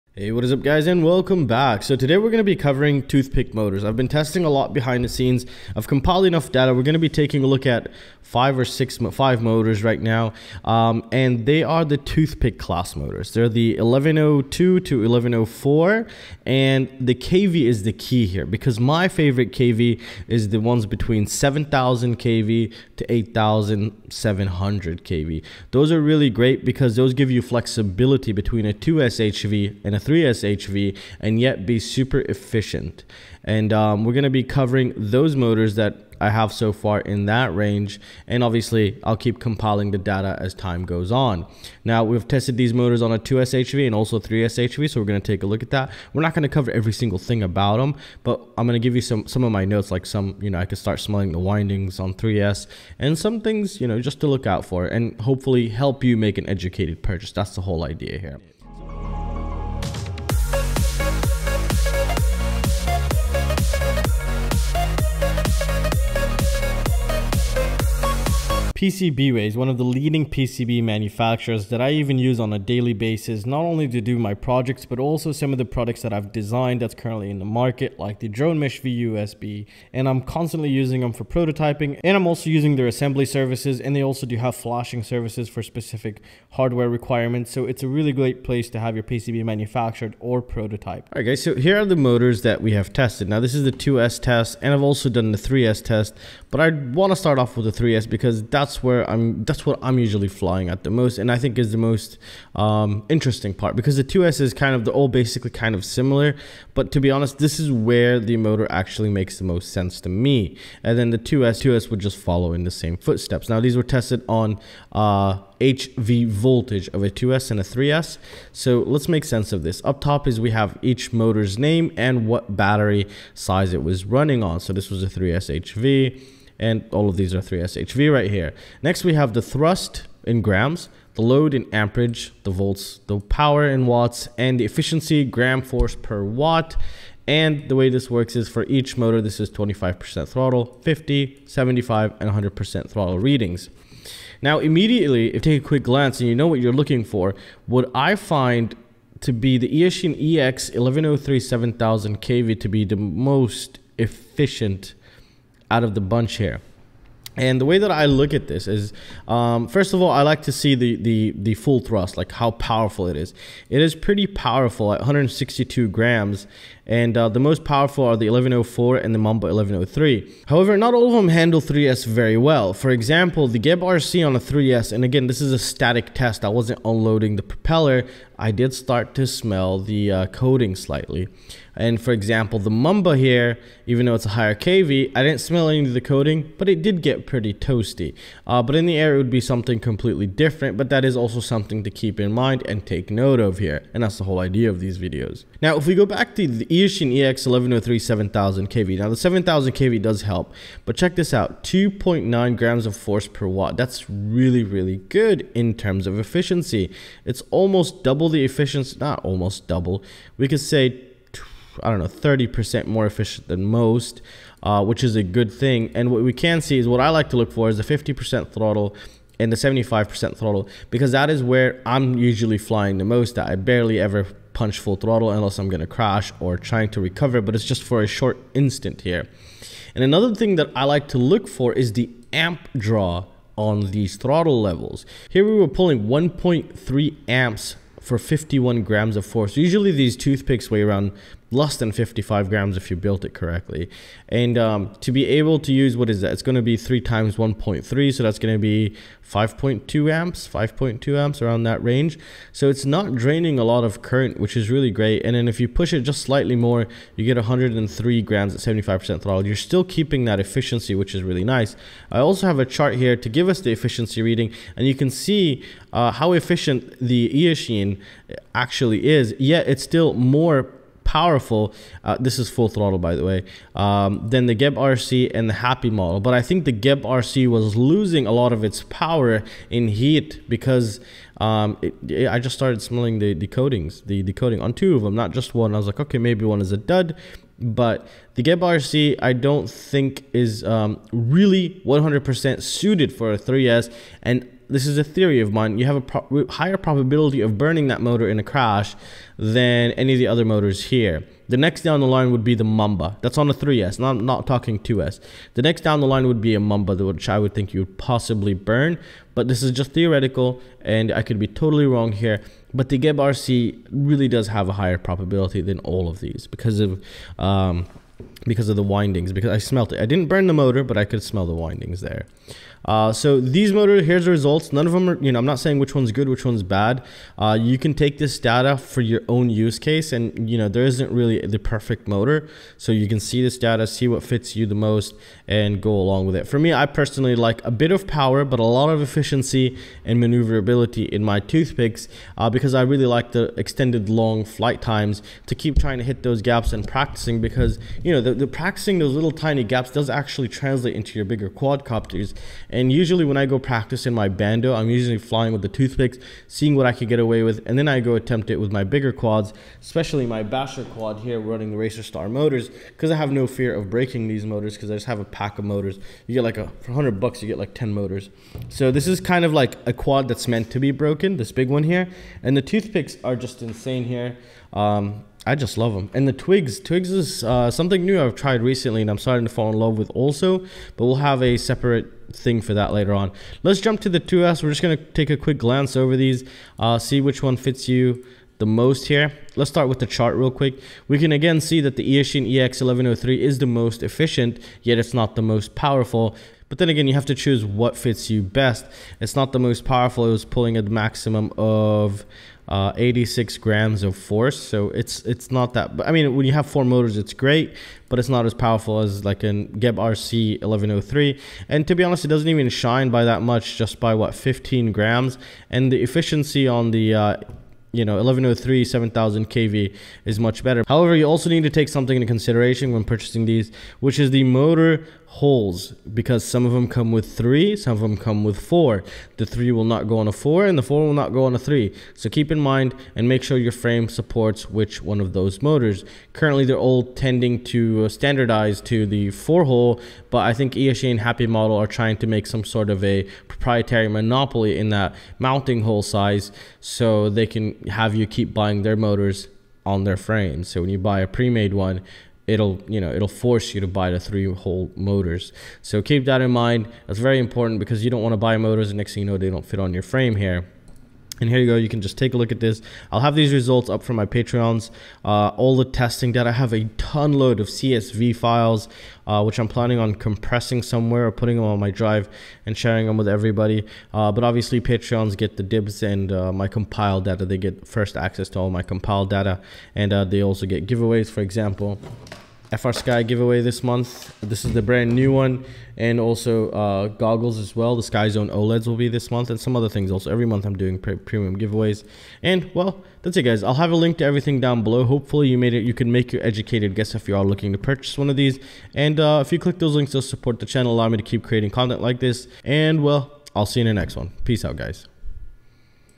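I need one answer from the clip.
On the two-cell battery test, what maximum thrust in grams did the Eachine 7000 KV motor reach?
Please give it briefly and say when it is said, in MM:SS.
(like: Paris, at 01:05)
86 grams, at 06:42.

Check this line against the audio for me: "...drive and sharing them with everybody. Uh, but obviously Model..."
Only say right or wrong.
wrong.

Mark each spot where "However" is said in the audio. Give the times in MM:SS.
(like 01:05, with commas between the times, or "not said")
02:50, 07:00.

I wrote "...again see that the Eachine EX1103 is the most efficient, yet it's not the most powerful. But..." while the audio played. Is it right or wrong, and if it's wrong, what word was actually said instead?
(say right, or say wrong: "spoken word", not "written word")
right.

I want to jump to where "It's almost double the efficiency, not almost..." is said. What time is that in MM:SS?
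03:27.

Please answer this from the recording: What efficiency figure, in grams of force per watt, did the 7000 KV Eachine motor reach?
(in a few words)
2.9.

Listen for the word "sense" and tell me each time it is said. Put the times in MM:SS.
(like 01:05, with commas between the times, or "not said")
01:49, 01:59.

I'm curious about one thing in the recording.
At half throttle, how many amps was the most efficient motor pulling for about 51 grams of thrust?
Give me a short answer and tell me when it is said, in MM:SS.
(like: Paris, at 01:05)
1.3 amps, at 03:56.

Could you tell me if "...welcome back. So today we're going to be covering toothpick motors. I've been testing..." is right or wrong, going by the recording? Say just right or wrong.
right.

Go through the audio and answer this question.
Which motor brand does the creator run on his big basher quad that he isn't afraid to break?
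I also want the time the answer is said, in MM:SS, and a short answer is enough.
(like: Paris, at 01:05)
Racerstar, at 06:01.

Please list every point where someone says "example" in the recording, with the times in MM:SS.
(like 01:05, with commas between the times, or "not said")
02:52, 03:02, 08:01.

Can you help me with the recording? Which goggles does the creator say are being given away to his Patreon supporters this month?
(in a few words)
Sky Zone OLEDs.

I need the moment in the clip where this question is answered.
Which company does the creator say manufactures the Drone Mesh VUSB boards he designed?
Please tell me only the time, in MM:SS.
01:08.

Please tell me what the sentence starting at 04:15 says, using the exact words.
And then if you push it just slightly more, you get 103 grams at 75% throttle.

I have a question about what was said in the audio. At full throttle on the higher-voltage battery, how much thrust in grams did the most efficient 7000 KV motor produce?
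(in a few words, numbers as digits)
162 grams.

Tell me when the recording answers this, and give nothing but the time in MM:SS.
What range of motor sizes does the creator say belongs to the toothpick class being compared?
00:13.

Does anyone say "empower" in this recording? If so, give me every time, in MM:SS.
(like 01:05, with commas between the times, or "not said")
not said.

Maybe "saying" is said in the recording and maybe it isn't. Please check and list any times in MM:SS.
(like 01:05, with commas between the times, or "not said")
05:25.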